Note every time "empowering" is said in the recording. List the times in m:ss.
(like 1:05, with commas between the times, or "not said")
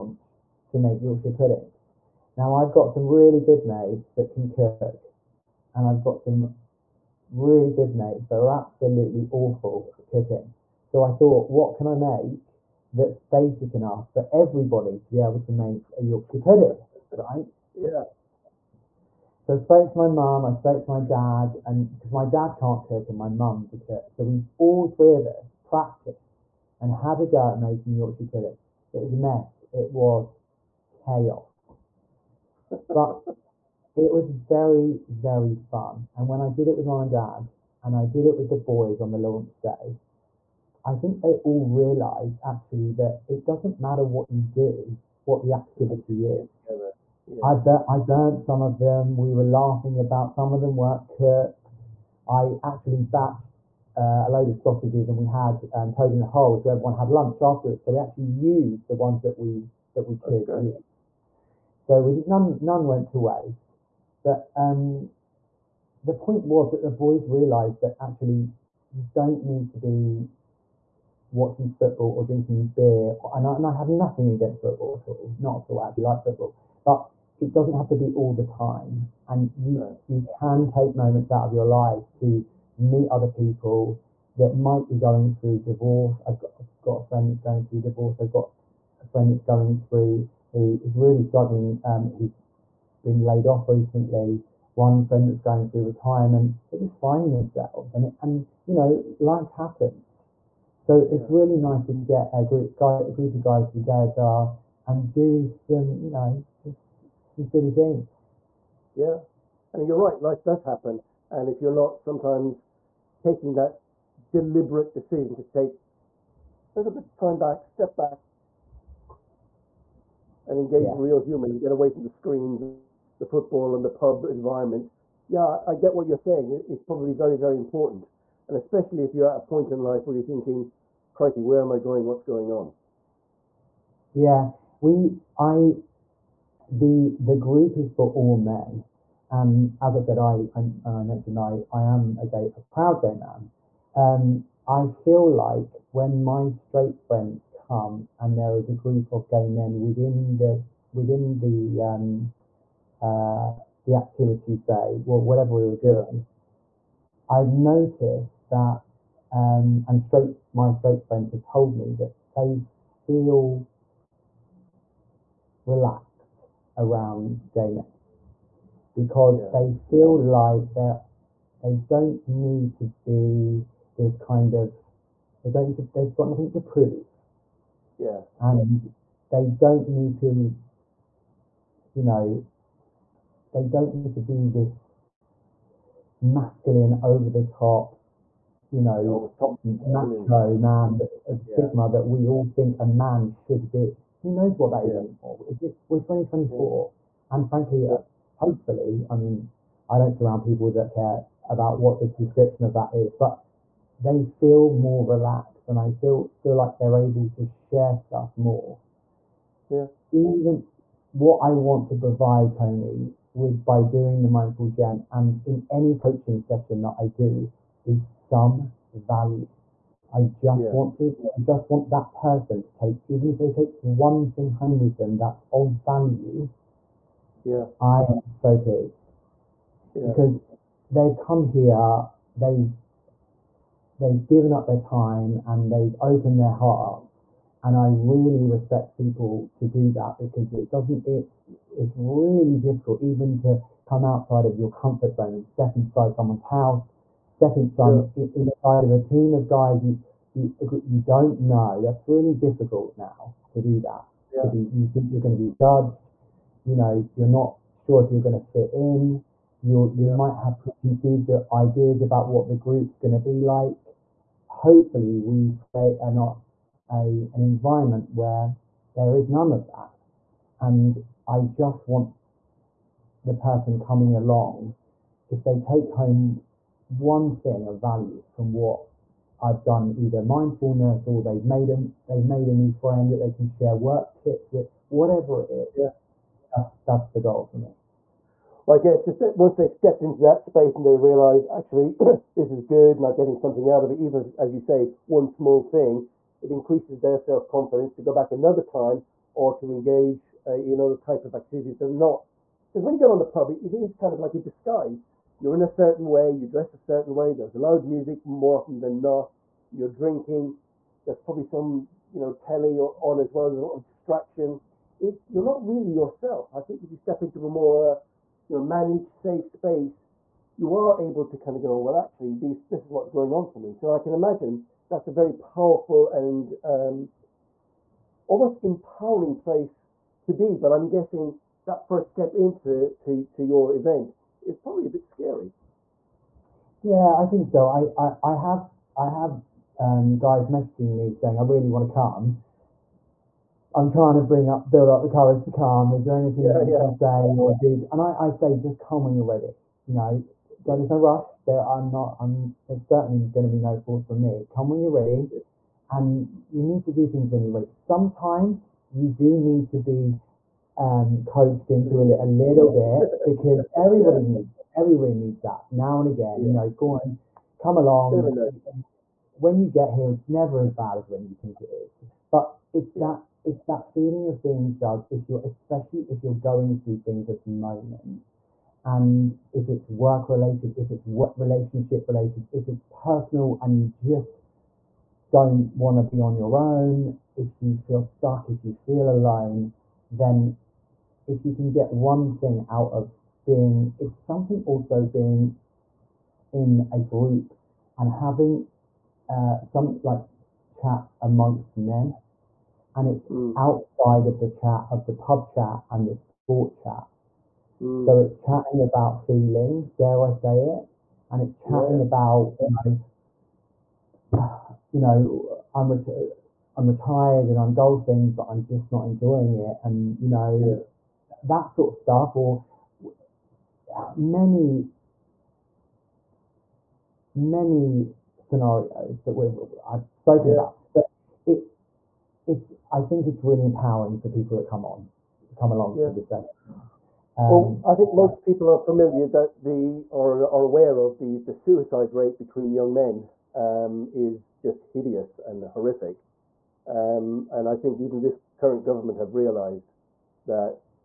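5:28, 7:13.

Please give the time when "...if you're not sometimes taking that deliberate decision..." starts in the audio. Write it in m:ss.
1:51.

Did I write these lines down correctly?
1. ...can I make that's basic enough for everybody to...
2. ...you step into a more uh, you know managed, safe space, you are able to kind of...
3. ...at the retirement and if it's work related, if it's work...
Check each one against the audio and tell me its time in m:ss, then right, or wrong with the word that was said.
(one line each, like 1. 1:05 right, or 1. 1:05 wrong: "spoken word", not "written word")
1. 0:11 right
2. 5:16 right
3. 6:17 wrong: "moment", not "retirement".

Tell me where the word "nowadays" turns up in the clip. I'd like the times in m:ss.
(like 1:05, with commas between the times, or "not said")
not said.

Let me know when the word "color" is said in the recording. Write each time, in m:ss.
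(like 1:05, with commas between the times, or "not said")
not said.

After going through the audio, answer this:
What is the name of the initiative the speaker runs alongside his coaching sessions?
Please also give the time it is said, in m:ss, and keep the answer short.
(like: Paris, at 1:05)
The Mindful Gent, at 3:34.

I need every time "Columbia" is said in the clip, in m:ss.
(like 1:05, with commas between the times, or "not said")
not said.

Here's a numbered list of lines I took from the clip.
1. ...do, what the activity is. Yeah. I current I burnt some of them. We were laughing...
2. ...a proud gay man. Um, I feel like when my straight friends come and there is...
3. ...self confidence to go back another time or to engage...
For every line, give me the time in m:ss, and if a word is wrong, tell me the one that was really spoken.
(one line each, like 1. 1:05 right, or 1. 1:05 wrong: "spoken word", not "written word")
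1. 0:44 wrong: "burnt", not "current"
2. 2:22 right
3. 4:57 right.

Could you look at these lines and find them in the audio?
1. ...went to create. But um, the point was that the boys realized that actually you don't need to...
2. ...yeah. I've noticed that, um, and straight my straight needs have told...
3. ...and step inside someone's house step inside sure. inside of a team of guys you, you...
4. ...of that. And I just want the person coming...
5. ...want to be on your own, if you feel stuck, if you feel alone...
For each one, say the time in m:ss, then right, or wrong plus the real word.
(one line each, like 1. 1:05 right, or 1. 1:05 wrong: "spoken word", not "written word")
1. 1:02 wrong: "waste", not "create"
2. 2:37 wrong: "friends", not "needs"
3. 4:05 right
4. 4:29 right
5. 6:25 right.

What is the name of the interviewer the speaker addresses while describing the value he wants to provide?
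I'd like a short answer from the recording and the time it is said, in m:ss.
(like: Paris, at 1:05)
Tony, at 3:32.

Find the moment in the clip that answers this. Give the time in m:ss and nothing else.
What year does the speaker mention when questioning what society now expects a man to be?
3:15.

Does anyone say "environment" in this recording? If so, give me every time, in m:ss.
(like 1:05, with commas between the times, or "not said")
2:04, 4:27.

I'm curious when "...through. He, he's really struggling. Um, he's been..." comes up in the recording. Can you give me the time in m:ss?
1:29.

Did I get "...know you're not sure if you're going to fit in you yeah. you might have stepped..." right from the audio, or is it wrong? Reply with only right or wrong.
wrong.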